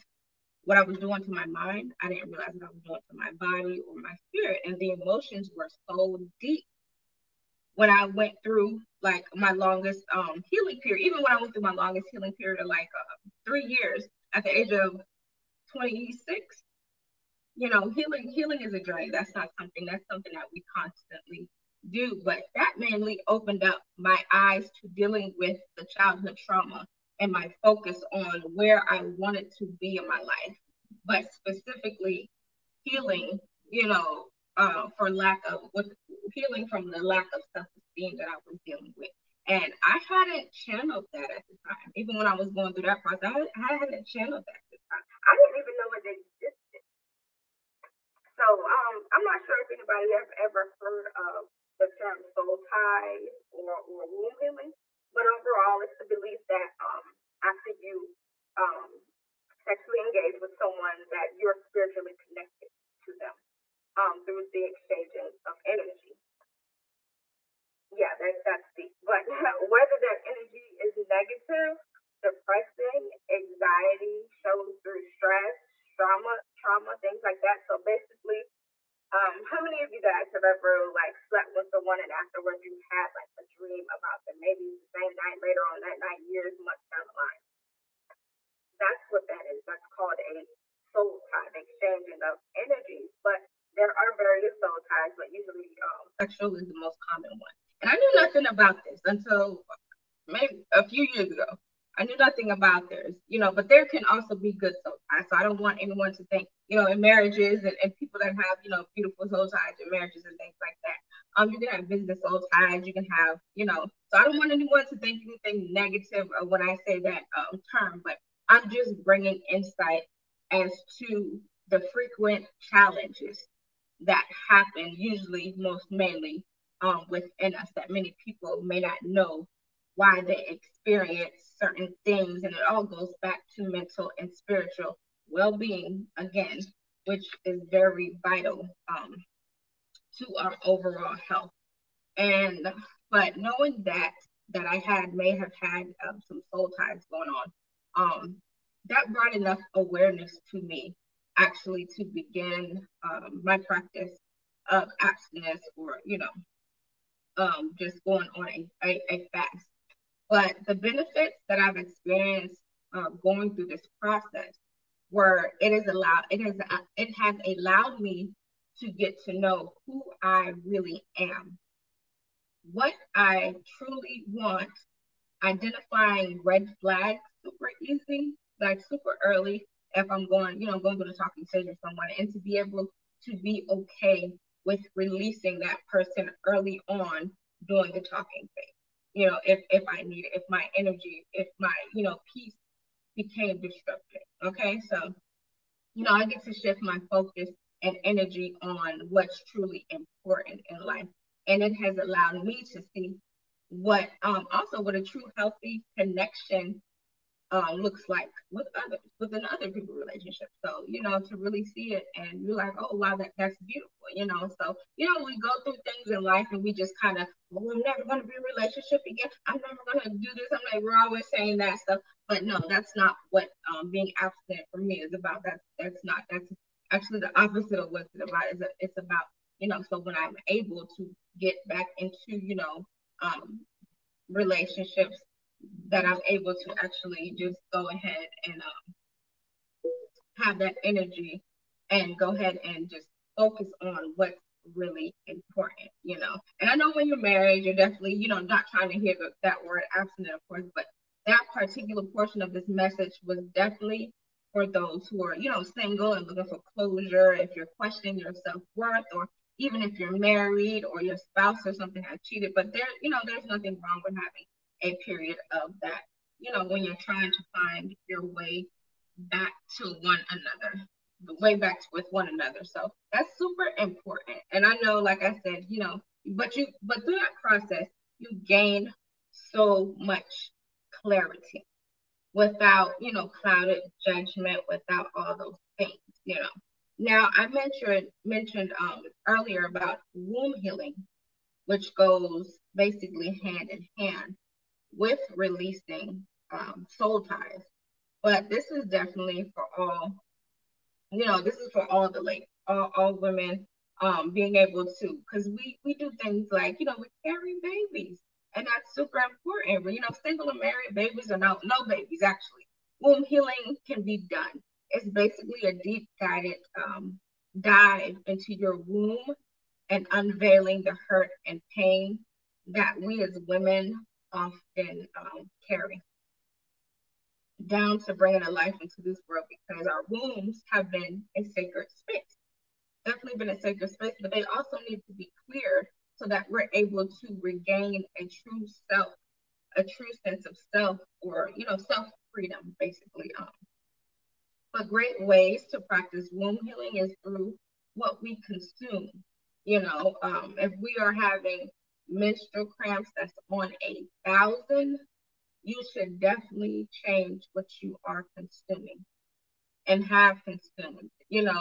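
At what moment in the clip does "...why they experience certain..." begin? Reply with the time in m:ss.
2:09.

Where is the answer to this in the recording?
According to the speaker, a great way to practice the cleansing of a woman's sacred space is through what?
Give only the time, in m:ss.
5:47.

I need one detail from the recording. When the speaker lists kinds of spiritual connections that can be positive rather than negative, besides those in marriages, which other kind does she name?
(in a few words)
business.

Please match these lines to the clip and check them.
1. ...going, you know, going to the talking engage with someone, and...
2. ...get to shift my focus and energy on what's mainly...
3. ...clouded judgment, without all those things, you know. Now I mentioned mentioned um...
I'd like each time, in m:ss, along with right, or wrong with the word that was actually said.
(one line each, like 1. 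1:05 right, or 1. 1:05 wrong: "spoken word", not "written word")
1. 3:00 wrong: "stage", not "engage"
2. 3:16 wrong: "truly", not "mainly"
3. 4:43 right.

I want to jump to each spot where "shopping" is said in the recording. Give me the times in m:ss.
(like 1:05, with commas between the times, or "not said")
not said.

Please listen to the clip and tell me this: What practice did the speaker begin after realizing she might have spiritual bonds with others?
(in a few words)
abstinence.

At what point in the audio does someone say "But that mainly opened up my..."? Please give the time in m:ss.
0:22.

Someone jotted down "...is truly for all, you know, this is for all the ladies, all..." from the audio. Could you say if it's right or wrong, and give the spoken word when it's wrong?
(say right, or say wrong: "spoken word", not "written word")
wrong: "definitely", not "truly".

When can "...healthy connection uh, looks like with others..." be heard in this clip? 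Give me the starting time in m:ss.
3:25.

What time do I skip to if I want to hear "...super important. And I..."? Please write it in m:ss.
4:33.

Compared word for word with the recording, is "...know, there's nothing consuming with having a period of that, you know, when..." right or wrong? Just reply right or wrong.
wrong.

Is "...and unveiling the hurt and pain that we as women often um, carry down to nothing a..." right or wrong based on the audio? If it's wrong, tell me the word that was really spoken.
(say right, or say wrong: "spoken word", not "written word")
wrong: "bringing", not "nothing".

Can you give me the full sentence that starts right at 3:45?
That's, that's not, that's actually the opposite of what it's about.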